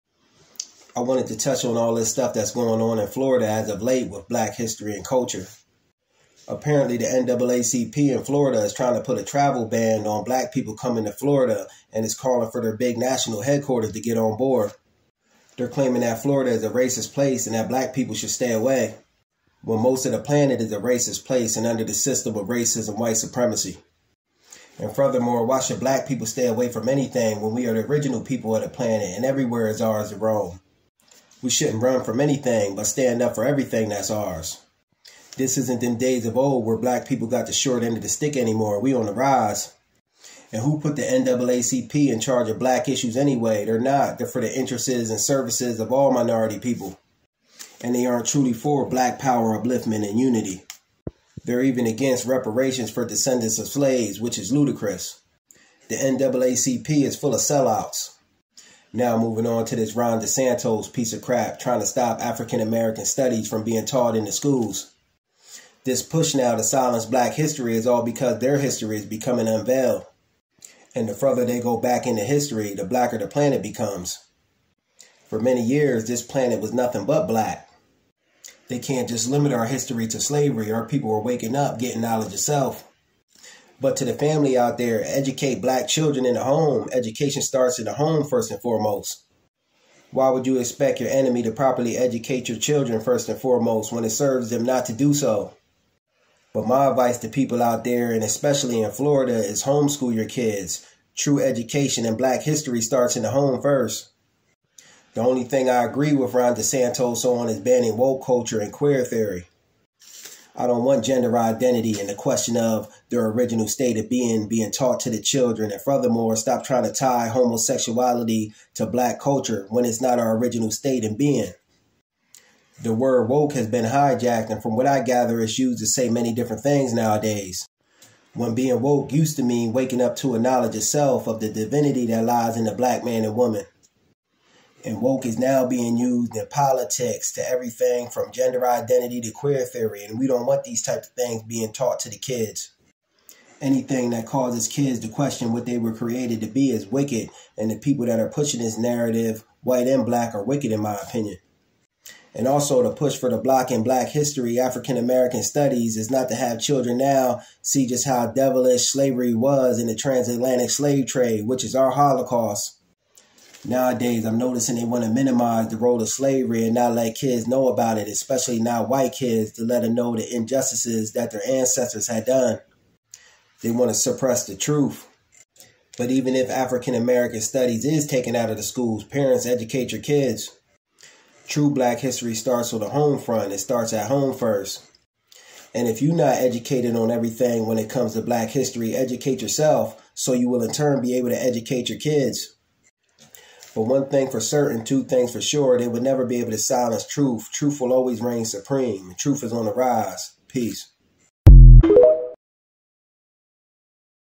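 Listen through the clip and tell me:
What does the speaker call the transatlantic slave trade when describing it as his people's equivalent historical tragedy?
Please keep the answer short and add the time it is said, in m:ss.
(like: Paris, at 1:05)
Our holocaust, at 2:41.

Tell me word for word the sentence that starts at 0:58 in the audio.
Now moving on to this Ron DeSantis piece of crap trying to stop African American studies from being taught in the schools.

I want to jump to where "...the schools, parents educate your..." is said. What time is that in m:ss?
2:58.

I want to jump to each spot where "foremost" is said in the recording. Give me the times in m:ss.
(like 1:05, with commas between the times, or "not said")
1:28, 1:33.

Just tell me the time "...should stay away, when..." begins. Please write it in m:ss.
0:18.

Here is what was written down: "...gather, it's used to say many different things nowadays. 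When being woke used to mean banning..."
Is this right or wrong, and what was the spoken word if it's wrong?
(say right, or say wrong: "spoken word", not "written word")
wrong: "waking", not "banning".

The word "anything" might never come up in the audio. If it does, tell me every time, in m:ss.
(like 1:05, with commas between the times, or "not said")
0:26, 0:32, 2:23.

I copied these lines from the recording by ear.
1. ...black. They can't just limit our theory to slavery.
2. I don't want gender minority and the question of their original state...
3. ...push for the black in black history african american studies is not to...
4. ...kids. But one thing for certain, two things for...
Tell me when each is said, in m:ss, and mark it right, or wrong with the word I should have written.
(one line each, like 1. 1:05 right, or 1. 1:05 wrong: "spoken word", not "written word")
1. 1:17 wrong: "history", not "theory"
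2. 1:50 wrong: "identity", not "minority"
3. 2:32 wrong: "block", not "black"
4. 3:11 right.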